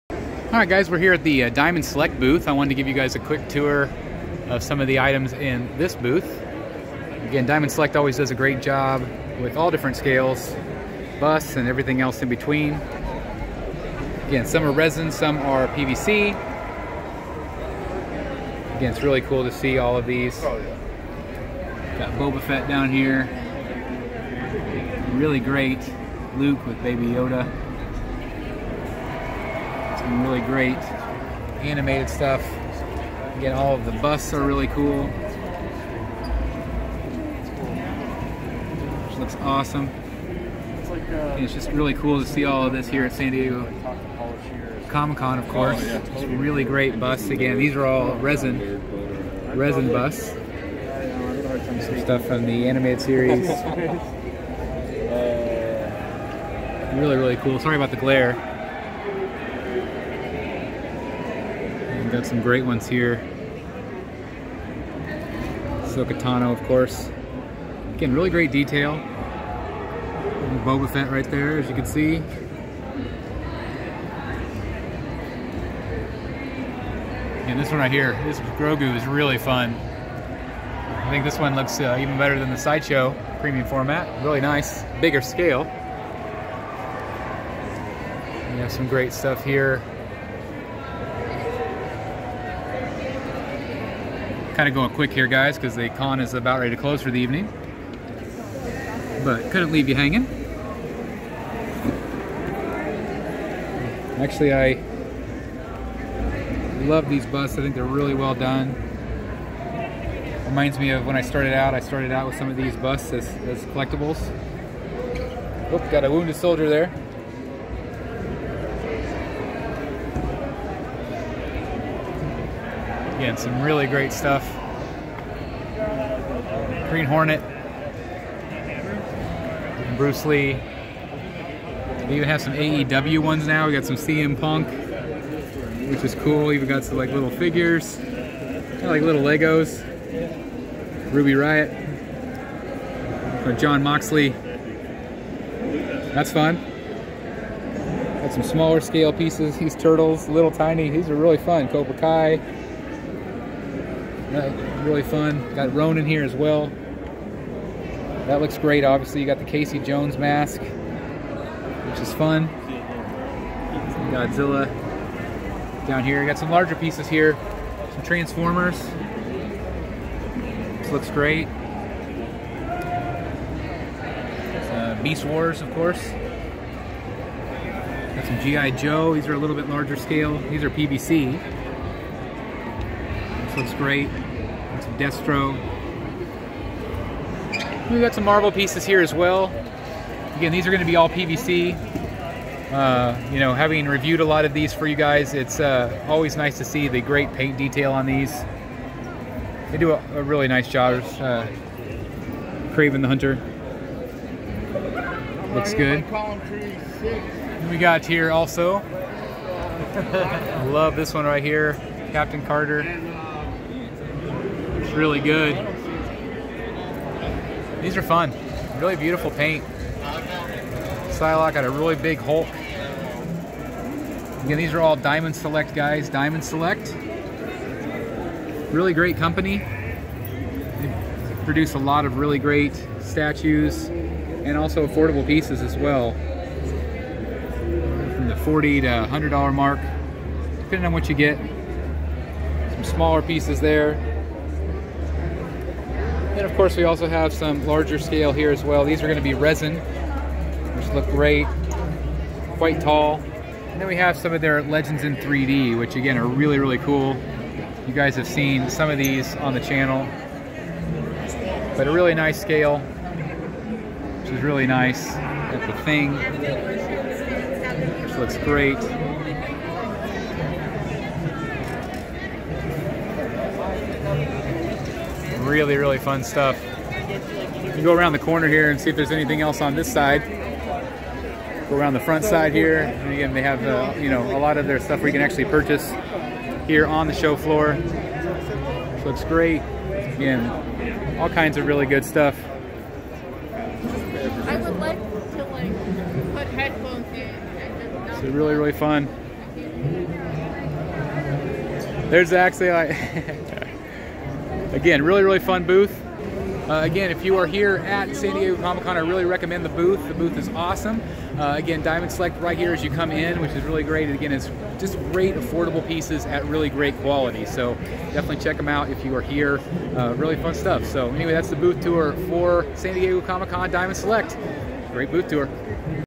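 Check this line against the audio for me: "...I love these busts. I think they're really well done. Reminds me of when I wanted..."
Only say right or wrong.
wrong.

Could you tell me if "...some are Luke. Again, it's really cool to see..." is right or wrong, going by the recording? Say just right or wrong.
wrong.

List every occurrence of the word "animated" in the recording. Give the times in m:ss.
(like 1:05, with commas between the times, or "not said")
0:31, 0:52.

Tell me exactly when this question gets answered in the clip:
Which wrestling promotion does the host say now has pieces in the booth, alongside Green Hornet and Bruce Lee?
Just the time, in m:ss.
2:12.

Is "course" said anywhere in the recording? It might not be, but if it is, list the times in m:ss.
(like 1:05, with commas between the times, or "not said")
0:45, 1:06, 2:55, 4:06.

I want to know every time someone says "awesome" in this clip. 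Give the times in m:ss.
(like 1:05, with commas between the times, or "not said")
0:39, 5:10.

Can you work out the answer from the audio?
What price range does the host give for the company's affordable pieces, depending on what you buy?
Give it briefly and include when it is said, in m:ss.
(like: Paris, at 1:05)
$40 to $100, at 3:58.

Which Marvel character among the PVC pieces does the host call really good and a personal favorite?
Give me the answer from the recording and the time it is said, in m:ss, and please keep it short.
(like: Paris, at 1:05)
Captain Carter, at 3:32.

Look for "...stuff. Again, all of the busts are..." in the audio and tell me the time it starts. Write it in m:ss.
0:32.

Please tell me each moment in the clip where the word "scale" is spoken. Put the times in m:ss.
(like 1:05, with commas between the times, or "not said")
0:09, 1:25, 2:28, 2:59, 4:07, 4:22.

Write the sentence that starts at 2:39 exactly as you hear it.
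You got the Casey Jones mask, which is fun.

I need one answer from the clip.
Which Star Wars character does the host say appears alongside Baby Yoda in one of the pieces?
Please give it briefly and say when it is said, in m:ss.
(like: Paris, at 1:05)
Luke, at 0:26.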